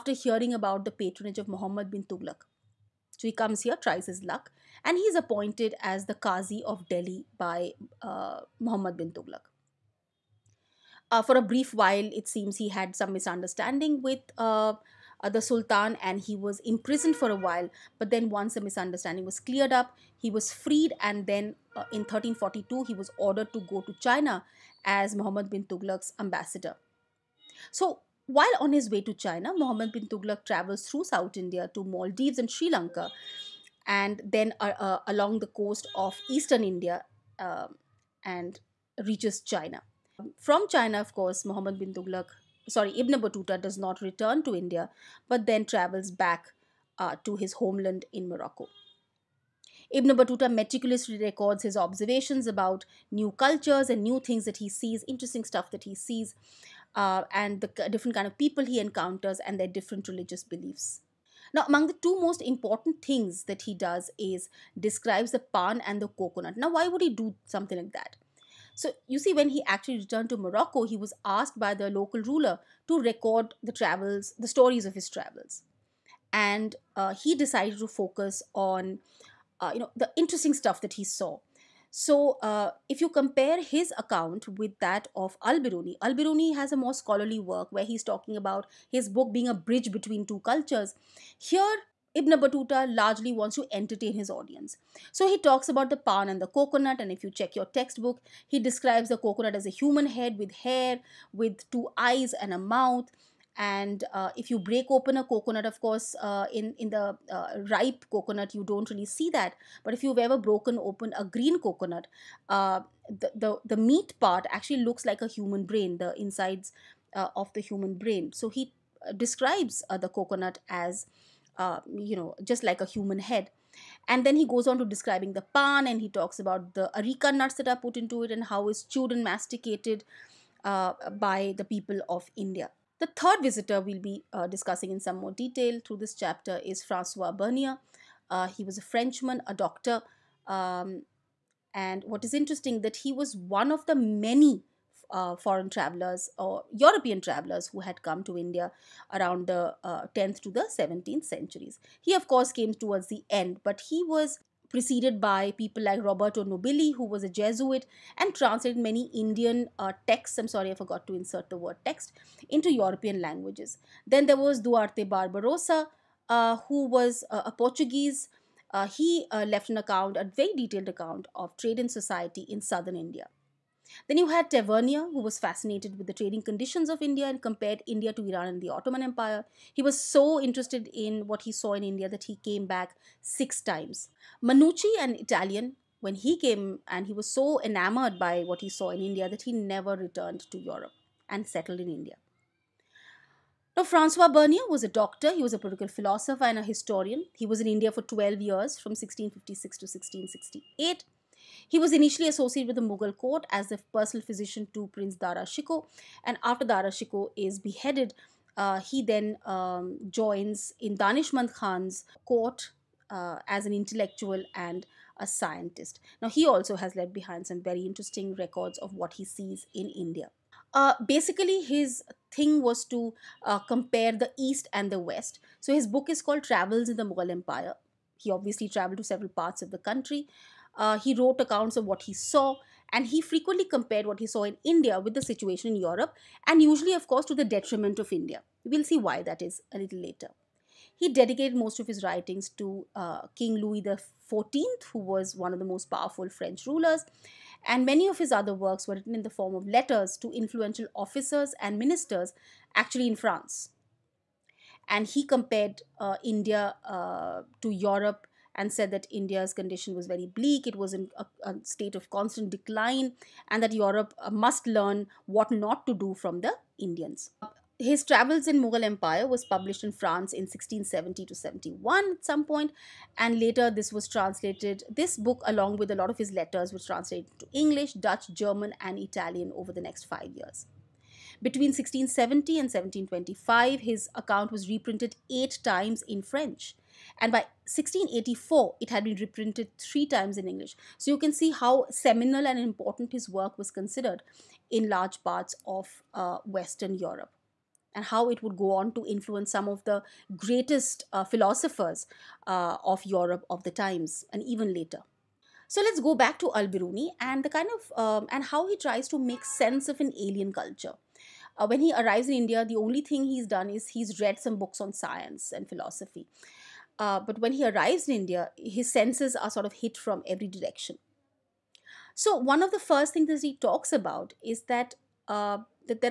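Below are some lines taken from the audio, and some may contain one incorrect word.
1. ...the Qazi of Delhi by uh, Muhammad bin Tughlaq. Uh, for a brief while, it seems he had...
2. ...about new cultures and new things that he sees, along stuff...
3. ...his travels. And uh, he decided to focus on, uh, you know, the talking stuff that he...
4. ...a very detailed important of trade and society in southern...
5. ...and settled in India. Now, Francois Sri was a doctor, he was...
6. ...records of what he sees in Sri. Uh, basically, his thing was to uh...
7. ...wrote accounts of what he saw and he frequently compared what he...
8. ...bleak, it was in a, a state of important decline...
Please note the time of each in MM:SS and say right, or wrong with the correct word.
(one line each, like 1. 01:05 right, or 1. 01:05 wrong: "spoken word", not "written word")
1. 00:06 right
2. 00:52 wrong: "interesting", not "along"
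3. 01:14 wrong: "interesting", not "talking"
4. 02:50 wrong: "account", not "important"
5. 03:11 wrong: "Bernier", not "Sri"
6. 03:38 wrong: "India", not "Sri"
7. 03:51 right
8. 04:20 wrong: "constant", not "important".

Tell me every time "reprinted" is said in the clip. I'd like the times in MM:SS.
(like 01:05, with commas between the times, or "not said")
04:44, 04:49.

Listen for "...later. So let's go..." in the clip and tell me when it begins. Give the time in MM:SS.
05:04.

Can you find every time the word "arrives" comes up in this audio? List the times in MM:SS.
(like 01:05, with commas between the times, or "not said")
05:11, 05:17.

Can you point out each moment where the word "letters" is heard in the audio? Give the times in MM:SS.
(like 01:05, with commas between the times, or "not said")
04:09, 04:36.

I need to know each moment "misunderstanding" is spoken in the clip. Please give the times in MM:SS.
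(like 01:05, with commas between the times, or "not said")
00:13, 00:18.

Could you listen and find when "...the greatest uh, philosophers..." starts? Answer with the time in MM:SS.
04:59.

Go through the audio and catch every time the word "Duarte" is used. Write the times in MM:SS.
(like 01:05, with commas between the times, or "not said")
02:44.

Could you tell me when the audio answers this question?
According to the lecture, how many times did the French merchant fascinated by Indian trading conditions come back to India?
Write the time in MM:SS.
03:03.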